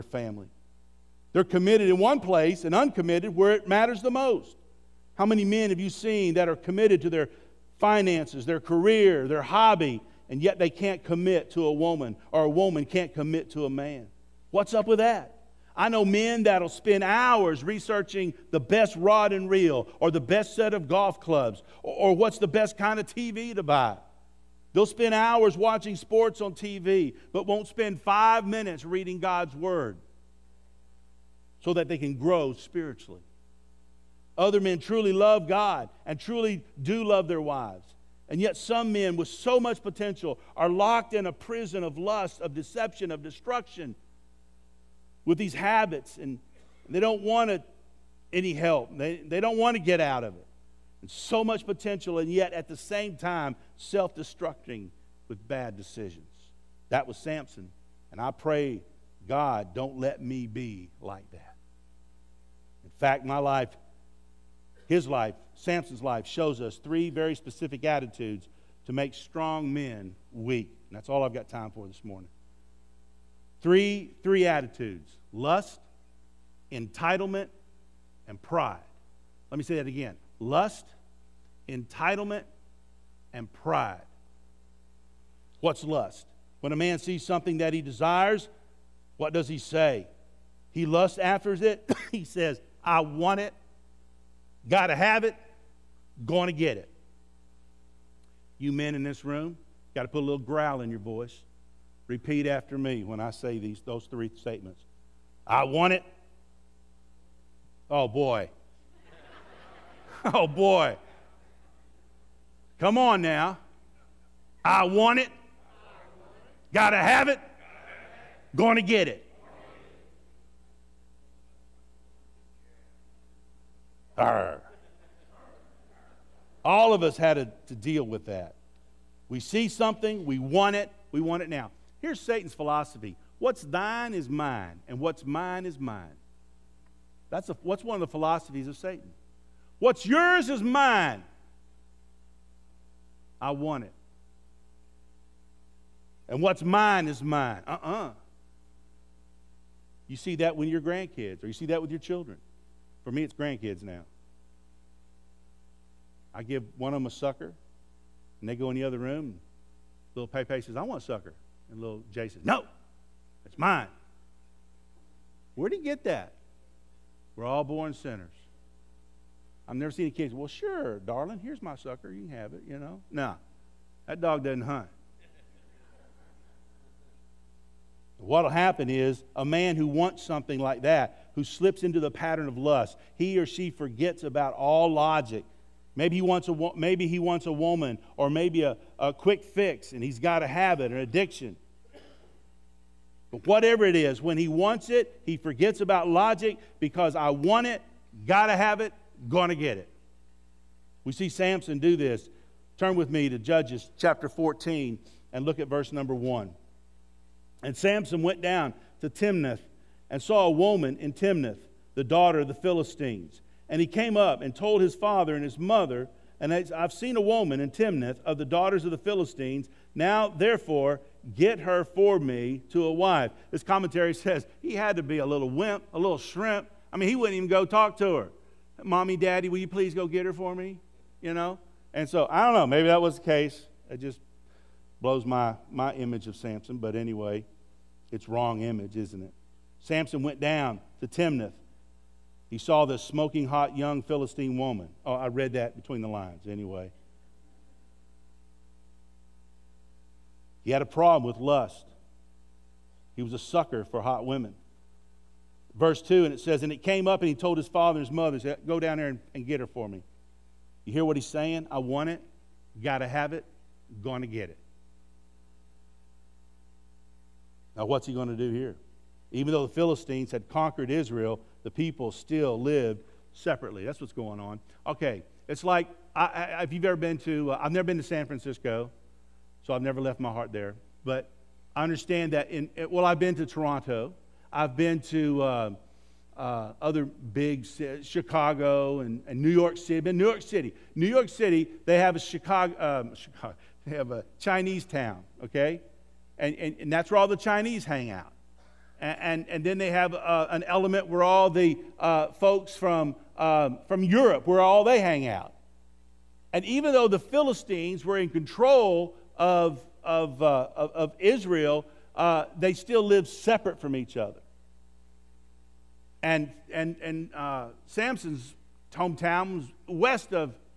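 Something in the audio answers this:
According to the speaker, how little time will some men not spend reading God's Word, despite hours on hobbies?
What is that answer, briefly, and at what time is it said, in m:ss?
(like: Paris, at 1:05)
5 minutes, at 0:28.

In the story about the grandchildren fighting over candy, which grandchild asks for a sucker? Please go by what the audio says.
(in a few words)
Pepe.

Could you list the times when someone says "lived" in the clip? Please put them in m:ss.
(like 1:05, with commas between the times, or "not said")
4:32, 5:13.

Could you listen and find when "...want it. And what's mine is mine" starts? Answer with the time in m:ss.
2:23.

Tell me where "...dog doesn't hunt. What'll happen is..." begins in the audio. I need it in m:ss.
2:54.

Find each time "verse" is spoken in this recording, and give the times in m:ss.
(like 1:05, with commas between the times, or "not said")
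3:25, 4:15.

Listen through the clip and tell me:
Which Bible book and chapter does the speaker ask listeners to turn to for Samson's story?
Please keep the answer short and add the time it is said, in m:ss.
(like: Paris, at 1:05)
Judges 14, at 3:23.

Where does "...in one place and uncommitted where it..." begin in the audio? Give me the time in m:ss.
0:01.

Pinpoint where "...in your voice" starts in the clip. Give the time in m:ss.
1:40.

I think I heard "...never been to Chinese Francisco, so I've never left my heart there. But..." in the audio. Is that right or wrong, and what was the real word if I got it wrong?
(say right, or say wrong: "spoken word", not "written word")
wrong: "San", not "Chinese".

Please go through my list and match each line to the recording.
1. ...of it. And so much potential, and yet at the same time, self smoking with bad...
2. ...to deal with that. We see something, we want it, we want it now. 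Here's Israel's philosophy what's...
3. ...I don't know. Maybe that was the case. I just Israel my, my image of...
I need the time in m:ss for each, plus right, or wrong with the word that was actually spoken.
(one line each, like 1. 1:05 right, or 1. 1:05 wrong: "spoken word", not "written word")
1. 0:50 wrong: "destructing", not "smoking"
2. 2:07 wrong: "Satan", not "Israel"
3. 3:52 wrong: "Blows", not "Israel".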